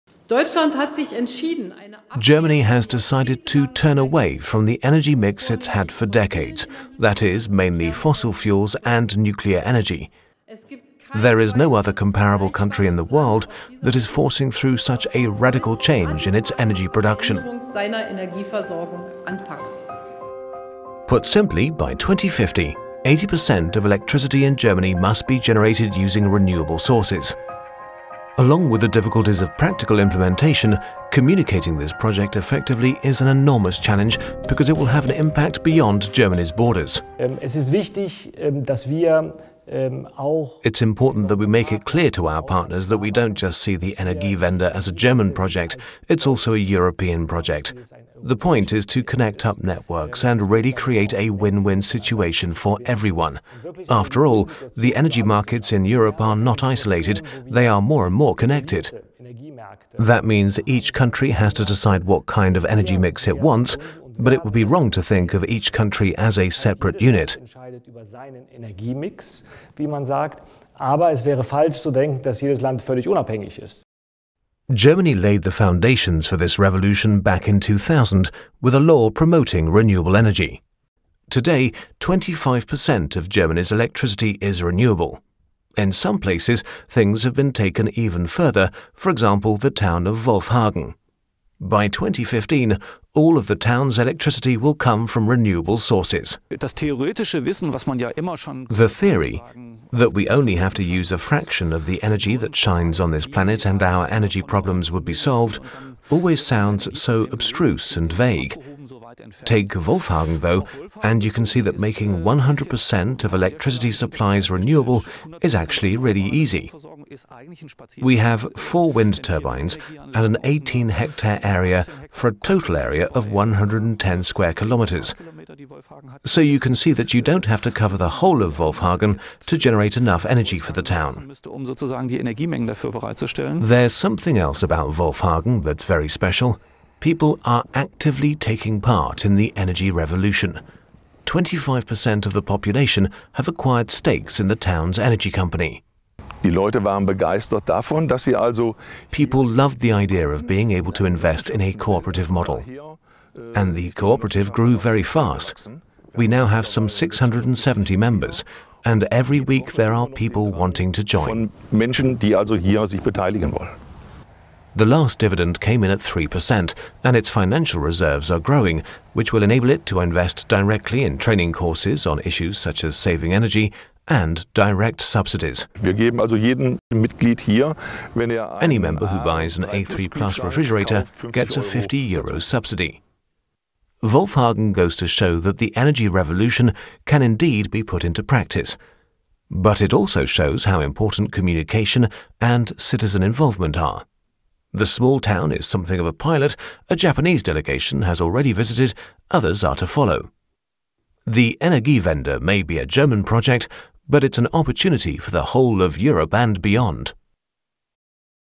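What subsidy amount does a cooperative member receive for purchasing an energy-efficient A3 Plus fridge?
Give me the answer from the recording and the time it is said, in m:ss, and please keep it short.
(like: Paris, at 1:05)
50 euros, at 3:01.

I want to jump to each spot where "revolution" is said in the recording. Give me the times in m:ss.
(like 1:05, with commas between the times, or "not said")
1:16, 2:19, 3:06.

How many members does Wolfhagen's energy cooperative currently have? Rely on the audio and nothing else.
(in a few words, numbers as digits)
670.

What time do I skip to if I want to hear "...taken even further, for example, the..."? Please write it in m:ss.
1:27.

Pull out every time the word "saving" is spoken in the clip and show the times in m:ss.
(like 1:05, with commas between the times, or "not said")
2:52.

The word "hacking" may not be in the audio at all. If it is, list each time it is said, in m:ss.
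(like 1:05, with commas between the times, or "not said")
not said.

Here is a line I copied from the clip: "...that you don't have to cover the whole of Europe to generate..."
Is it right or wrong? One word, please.
wrong.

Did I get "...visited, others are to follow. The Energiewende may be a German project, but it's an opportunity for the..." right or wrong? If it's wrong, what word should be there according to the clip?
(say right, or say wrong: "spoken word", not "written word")
right.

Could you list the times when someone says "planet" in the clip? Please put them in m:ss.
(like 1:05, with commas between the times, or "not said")
1:43.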